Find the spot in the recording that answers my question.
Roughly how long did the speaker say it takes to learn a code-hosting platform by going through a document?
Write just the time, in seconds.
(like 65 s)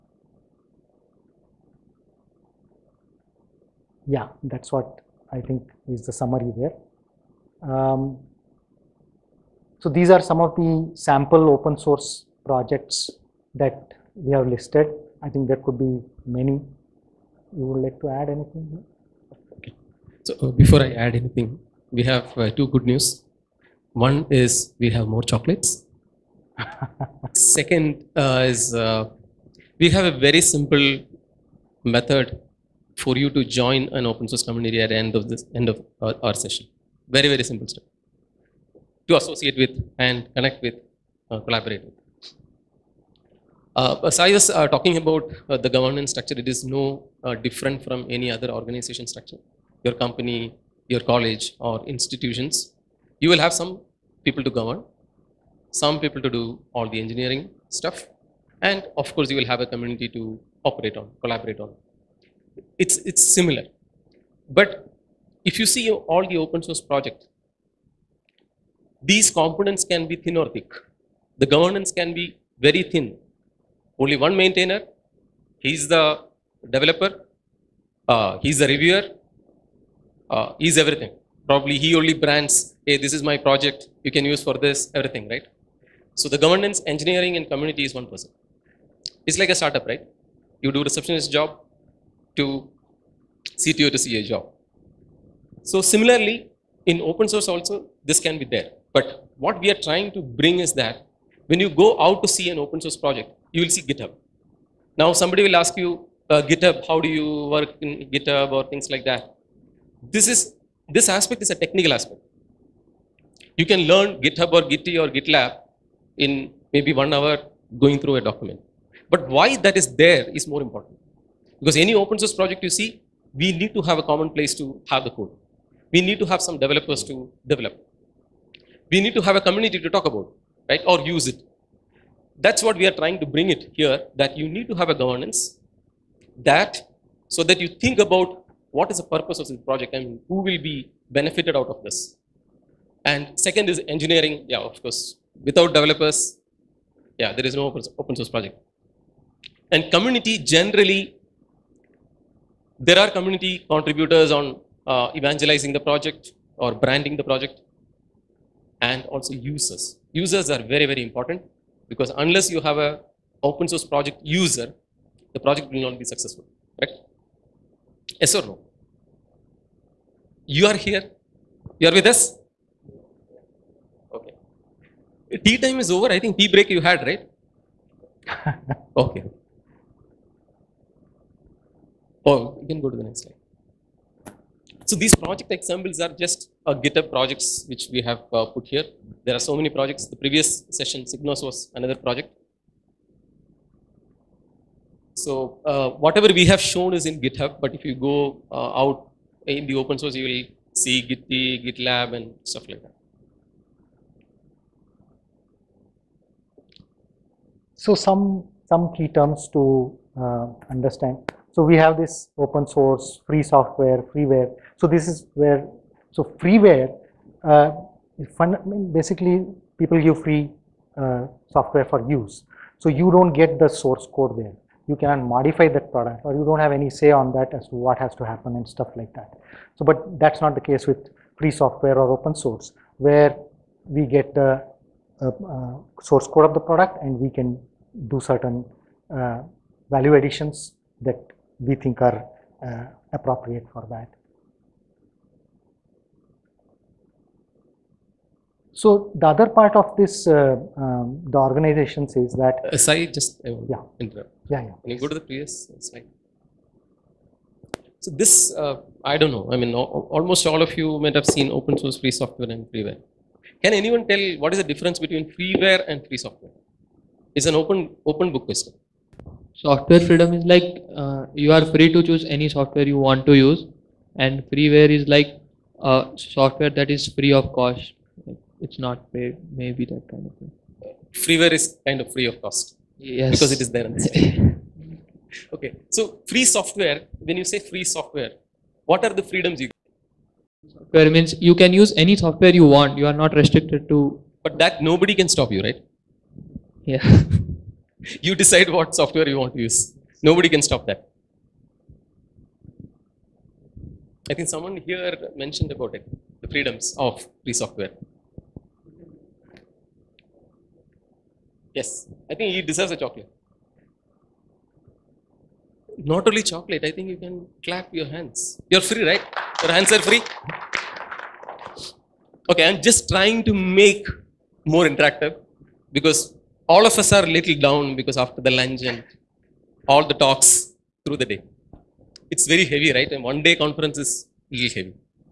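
116 s.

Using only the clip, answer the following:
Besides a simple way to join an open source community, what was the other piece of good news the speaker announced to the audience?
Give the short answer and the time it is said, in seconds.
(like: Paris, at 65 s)
More chocolates, at 24 s.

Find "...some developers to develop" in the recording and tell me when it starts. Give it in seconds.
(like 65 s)
126 s.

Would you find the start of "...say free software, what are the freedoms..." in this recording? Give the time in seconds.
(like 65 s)
287 s.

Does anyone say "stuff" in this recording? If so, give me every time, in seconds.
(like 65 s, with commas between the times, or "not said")
37 s, 57 s, 202 s, 228 s.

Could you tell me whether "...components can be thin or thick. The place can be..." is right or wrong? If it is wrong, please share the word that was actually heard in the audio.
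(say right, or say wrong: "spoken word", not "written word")
wrong: "governance", not "place".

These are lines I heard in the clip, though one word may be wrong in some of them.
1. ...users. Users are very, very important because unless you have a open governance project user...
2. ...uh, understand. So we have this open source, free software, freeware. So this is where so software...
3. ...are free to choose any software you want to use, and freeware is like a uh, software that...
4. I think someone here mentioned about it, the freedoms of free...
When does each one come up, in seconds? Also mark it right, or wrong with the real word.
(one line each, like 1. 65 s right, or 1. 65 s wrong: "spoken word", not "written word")
1. 159 s wrong: "source", not "governance"
2. 210 s wrong: "freeware", not "software"
3. 271 s right
4. 304 s right.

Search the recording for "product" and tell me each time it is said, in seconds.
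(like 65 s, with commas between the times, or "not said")
225 s, 236 s.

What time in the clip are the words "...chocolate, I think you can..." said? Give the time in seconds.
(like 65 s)
316 s.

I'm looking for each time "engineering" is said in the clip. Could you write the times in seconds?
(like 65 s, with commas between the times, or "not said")
56 s, 86 s, 143 s.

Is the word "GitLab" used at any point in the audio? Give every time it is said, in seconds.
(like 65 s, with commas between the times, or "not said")
115 s, 201 s.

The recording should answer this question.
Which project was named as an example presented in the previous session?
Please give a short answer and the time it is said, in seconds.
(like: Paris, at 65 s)
SigNoz, at 191 s.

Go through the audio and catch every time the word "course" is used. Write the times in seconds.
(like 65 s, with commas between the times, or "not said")
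59 s, 144 s.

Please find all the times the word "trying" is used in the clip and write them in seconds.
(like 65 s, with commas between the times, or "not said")
99 s, 132 s, 323 s.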